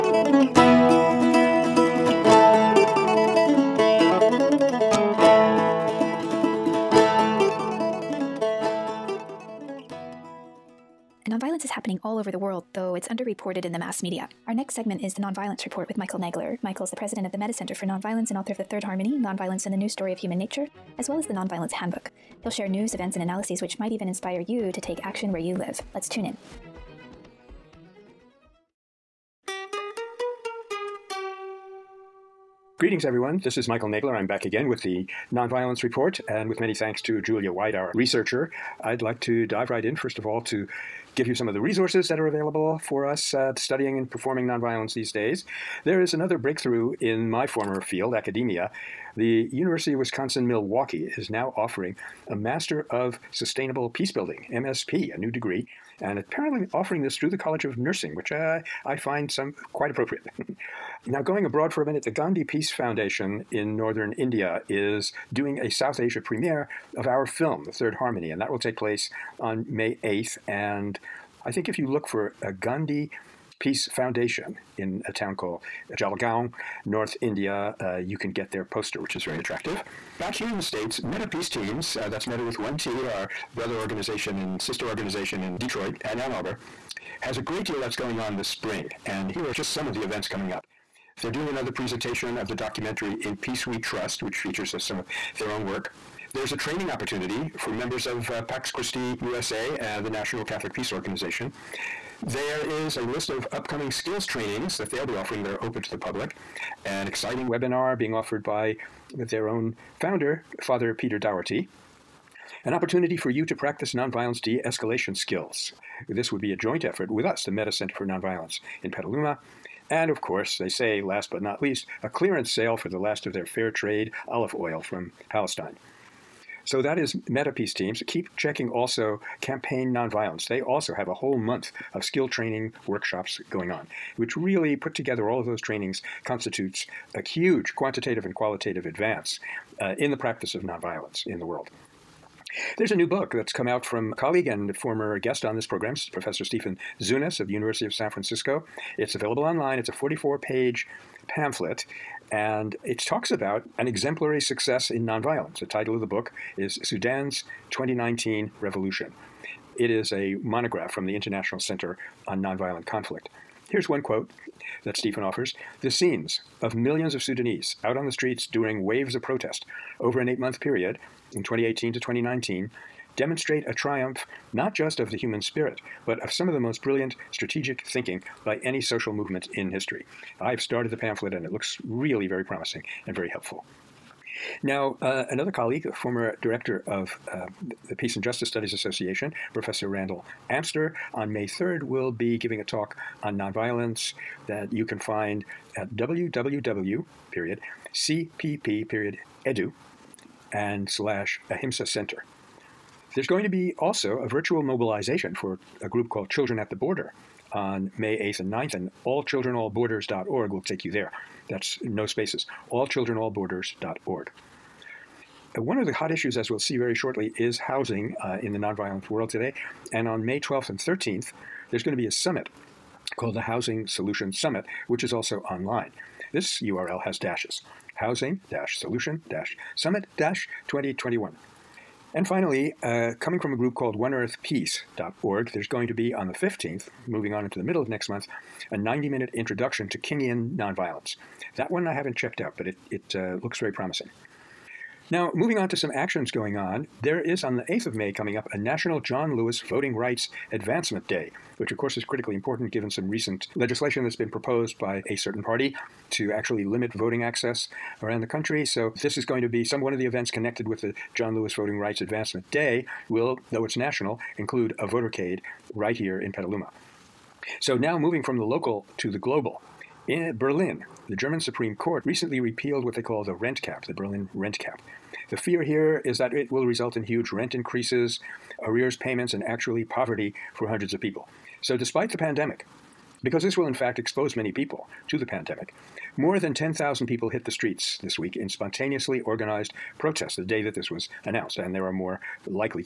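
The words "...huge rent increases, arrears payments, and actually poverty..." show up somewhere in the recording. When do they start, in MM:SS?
04:37.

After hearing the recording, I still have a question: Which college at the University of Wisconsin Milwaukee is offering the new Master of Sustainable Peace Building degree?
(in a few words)
College of Nursing.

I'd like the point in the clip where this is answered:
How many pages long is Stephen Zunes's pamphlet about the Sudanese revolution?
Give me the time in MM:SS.
02:29.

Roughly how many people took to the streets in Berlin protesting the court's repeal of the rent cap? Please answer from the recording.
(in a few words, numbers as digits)
More than 10,000.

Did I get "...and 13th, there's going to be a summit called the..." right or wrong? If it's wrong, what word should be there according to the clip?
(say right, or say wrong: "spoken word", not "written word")
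right.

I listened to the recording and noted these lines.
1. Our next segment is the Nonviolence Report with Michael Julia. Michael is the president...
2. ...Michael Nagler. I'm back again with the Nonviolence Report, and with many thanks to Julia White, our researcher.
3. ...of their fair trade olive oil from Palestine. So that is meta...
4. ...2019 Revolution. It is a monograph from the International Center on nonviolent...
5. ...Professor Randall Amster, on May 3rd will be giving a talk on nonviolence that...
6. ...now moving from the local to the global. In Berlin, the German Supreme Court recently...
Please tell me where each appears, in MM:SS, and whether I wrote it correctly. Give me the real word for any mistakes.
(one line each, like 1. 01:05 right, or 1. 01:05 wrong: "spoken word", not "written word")
1. 00:14 wrong: "Nagler", not "Julia"
2. 00:33 right
3. 02:03 right
4. 02:37 right
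5. 03:09 right
6. 04:27 right.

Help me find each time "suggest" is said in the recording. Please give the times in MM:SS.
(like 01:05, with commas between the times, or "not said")
not said.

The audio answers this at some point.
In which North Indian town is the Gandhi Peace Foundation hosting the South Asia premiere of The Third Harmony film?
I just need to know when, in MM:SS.
01:15.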